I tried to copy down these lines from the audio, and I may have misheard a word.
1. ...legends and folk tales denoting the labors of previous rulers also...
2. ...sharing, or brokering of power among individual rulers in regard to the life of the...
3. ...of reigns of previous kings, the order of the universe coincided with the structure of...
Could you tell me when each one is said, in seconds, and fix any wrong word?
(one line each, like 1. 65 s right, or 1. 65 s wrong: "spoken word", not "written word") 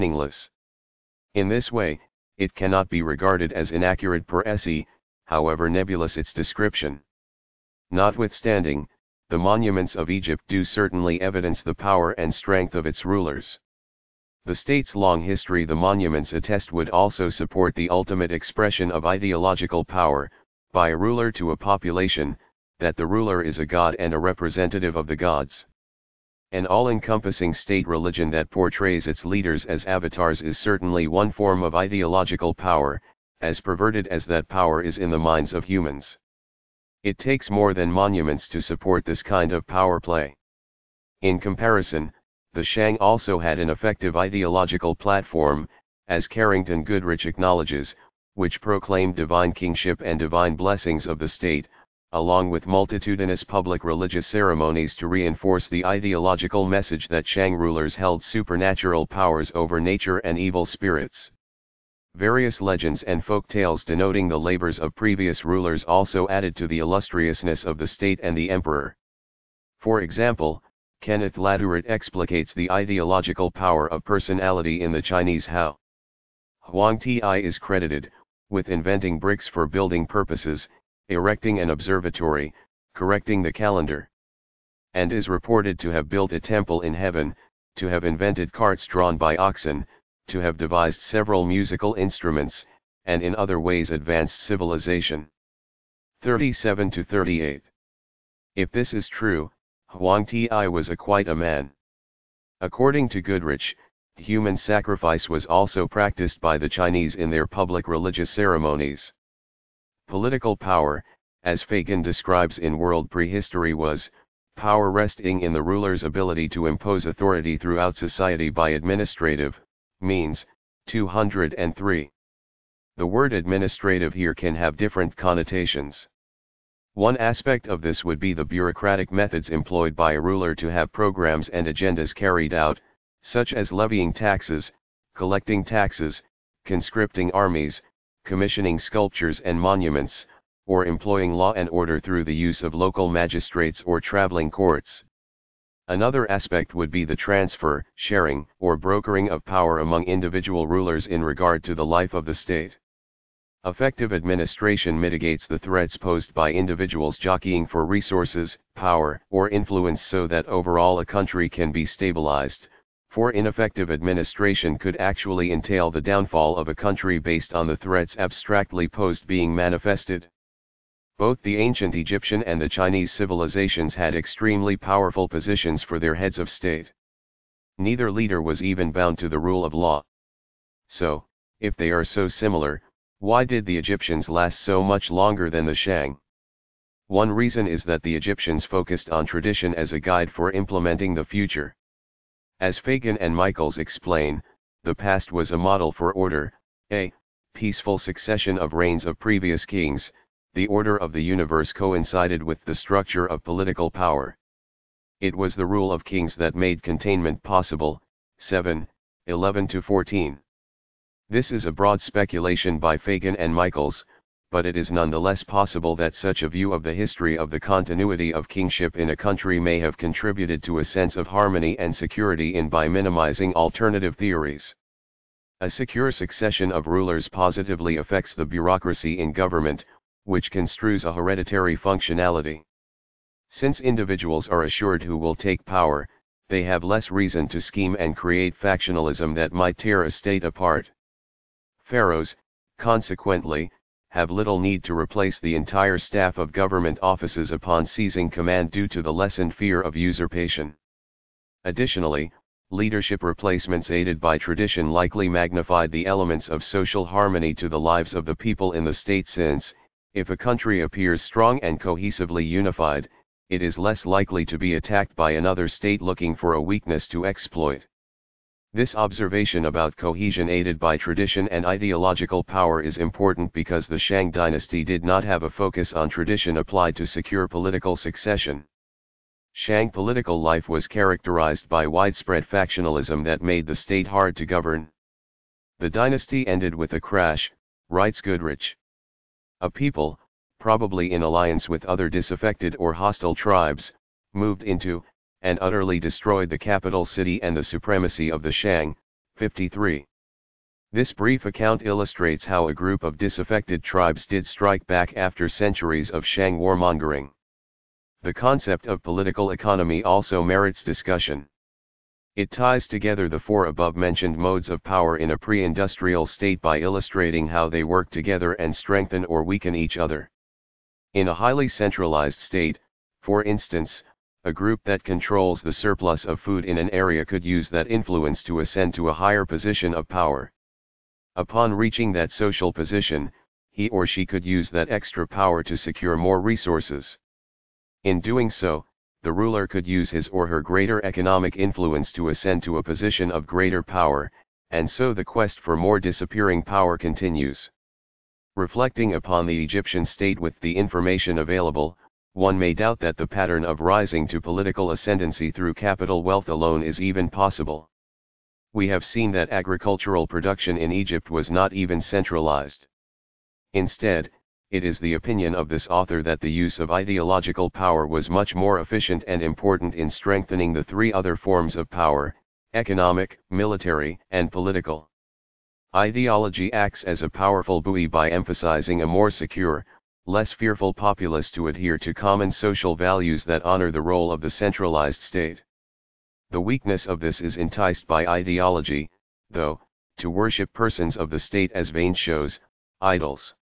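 1. 62 s right
2. 147 s right
3. 198 s right.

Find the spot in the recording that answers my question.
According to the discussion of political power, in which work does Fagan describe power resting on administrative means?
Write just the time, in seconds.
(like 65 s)
112 s.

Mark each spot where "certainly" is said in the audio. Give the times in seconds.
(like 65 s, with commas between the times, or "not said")
10 s, 30 s.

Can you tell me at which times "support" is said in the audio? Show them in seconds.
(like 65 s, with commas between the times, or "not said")
17 s, 38 s.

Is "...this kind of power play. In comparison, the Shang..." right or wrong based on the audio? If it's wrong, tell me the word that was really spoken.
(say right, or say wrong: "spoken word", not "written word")
right.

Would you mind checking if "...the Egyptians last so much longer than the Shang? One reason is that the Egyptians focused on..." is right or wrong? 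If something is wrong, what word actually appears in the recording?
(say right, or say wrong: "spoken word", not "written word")
right.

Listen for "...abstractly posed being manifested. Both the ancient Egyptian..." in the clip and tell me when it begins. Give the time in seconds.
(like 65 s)
168 s.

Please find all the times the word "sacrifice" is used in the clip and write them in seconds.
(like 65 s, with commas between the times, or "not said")
104 s.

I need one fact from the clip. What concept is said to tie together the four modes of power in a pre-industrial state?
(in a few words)
political economy.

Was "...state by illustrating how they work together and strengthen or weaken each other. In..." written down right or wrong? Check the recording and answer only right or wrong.
right.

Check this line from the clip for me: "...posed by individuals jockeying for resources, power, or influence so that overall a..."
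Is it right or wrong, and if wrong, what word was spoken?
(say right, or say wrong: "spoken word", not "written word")
right.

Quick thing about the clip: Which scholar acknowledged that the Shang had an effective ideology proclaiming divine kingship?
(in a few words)
Carrington Goodrich.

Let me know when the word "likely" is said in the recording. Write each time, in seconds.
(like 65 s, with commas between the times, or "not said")
254 s, 264 s.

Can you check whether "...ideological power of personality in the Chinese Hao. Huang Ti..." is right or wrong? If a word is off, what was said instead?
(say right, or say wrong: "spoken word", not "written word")
right.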